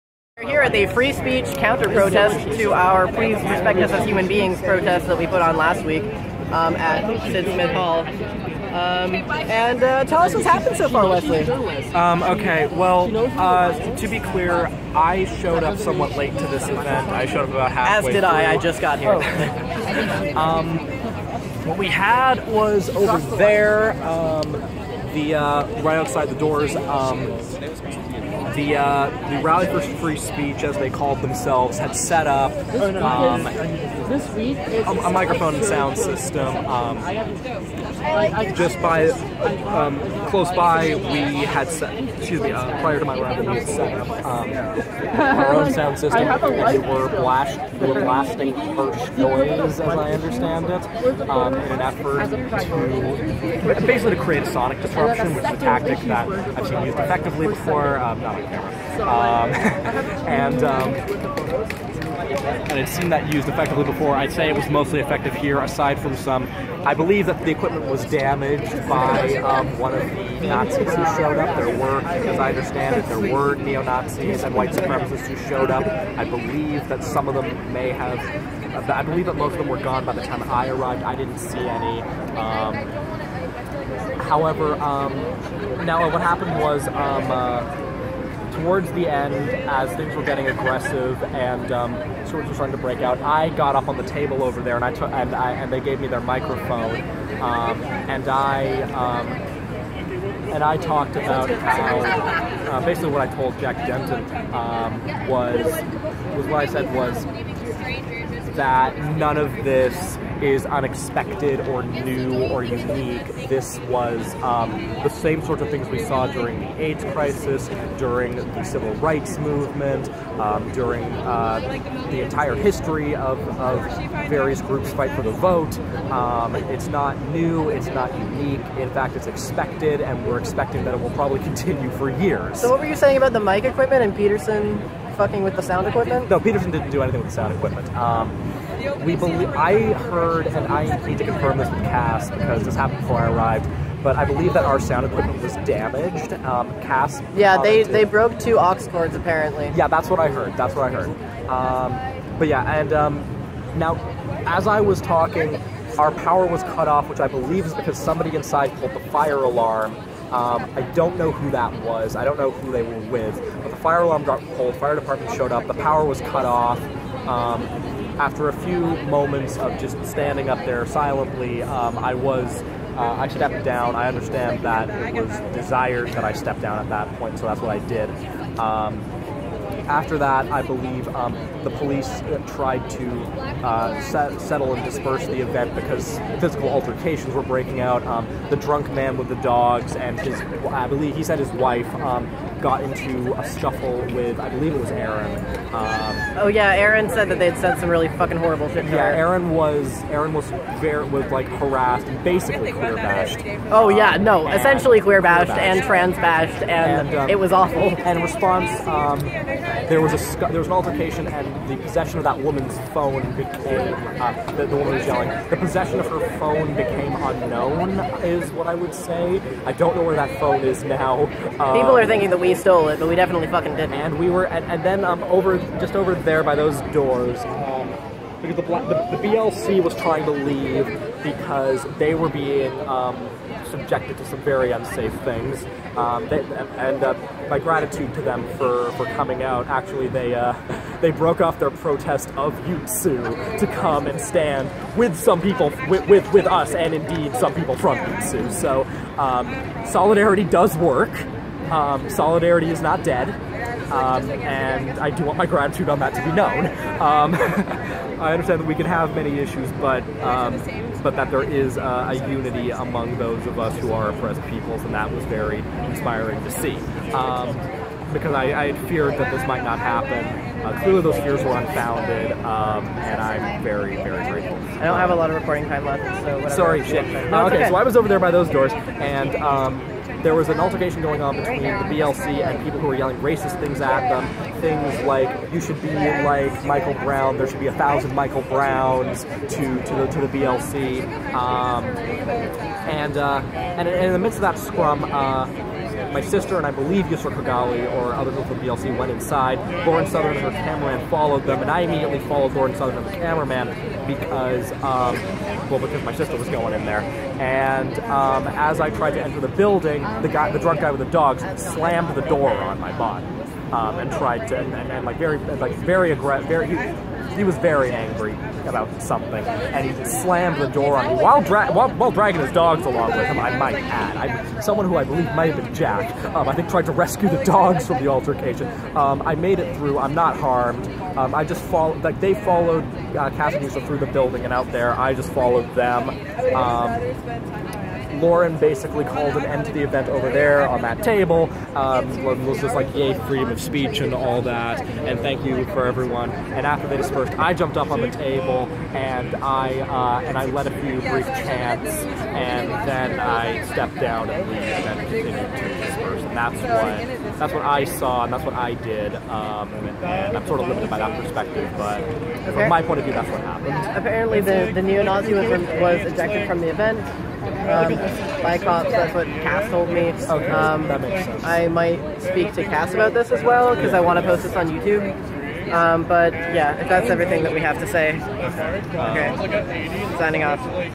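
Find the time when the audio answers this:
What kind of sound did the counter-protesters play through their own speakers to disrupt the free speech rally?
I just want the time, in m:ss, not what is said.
0:48.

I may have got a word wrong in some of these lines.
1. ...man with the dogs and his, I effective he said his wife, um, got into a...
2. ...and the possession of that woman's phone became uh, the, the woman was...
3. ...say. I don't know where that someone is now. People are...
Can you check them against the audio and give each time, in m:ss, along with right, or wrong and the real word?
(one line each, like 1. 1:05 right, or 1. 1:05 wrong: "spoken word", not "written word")
1. 3:08 wrong: "believe", not "effective"
2. 3:31 right
3. 3:38 wrong: "phone", not "someone".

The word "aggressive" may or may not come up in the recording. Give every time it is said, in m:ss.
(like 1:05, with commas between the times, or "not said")
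1:30, 5:16.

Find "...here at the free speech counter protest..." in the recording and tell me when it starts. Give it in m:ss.
0:00.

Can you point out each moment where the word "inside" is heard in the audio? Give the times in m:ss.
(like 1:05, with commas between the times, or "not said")
2:38, 4:59.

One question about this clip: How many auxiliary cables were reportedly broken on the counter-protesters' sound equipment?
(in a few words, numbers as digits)
2.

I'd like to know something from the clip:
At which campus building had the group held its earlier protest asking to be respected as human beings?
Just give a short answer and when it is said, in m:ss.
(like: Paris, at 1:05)
Sid Smith Hall, at 0:07.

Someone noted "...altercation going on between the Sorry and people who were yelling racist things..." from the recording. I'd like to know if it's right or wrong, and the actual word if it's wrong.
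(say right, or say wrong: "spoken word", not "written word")
wrong: "BLC", not "Sorry".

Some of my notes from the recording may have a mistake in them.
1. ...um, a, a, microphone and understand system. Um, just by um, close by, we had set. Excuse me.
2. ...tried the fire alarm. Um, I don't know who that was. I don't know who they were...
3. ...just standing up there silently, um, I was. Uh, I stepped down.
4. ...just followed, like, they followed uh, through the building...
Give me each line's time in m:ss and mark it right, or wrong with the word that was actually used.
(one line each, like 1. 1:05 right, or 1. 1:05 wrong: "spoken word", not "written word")
1. 0:32 wrong: "sound", not "understand"
2. 2:38 wrong: "pulled", not "tried"
3. 2:49 right
4. 5:31 right.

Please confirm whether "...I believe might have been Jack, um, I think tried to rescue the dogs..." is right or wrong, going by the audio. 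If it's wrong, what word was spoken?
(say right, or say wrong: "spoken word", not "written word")
right.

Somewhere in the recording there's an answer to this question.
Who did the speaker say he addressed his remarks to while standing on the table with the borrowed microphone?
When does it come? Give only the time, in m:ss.
1:43.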